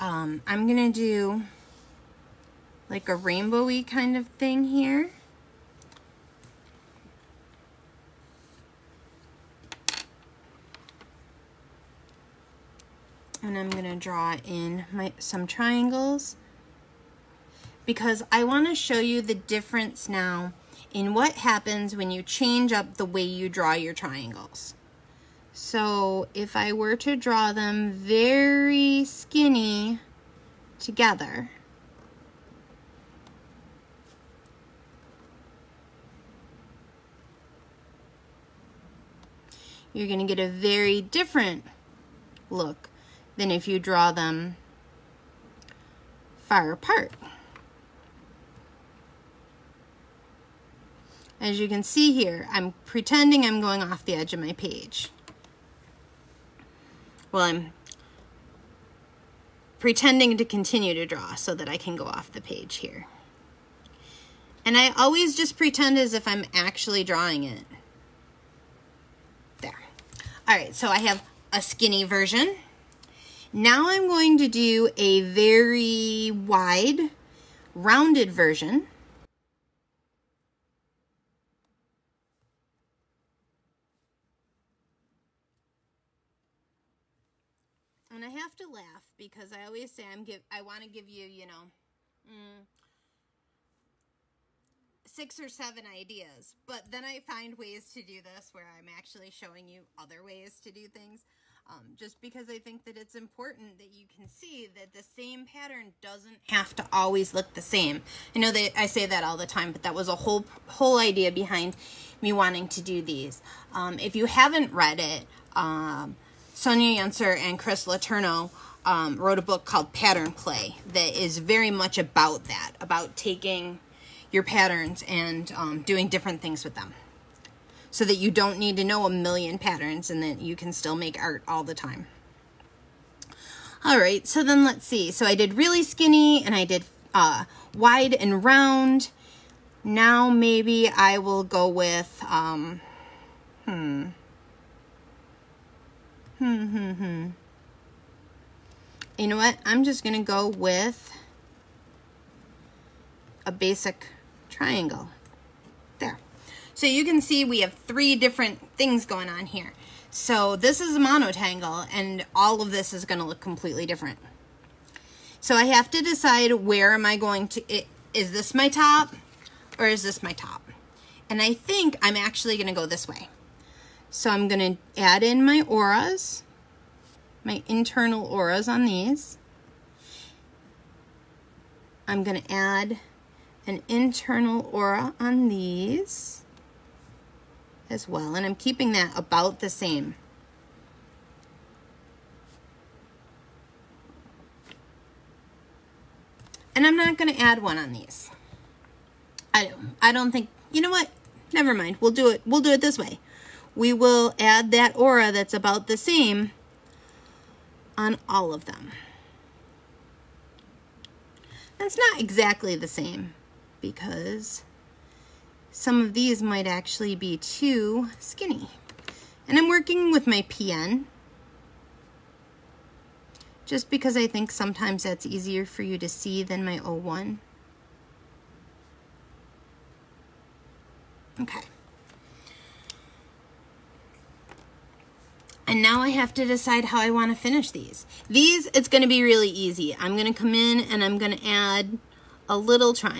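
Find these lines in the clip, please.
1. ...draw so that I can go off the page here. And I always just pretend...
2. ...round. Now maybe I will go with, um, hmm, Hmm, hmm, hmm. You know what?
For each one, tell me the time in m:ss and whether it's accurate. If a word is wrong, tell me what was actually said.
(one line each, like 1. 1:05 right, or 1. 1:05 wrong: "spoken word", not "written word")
1. 1:01 right
2. 2:18 right.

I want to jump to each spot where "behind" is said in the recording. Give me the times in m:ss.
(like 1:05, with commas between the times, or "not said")
1:51.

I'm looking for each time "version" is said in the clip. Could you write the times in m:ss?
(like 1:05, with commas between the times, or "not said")
1:12, 1:18.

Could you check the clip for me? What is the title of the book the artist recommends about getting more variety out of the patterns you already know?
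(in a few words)
Pattern Play.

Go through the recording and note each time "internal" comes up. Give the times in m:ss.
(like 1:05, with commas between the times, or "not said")
2:57, 3:03.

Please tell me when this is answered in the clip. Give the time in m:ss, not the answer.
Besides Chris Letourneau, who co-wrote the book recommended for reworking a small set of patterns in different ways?
1:56.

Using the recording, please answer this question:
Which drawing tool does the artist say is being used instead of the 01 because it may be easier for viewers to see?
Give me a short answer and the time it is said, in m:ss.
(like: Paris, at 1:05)
PN, at 3:40.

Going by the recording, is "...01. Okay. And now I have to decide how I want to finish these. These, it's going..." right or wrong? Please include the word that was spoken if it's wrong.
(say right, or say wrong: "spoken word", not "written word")
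right.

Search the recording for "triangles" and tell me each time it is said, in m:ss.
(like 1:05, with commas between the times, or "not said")
0:15, 0:23, 2:34.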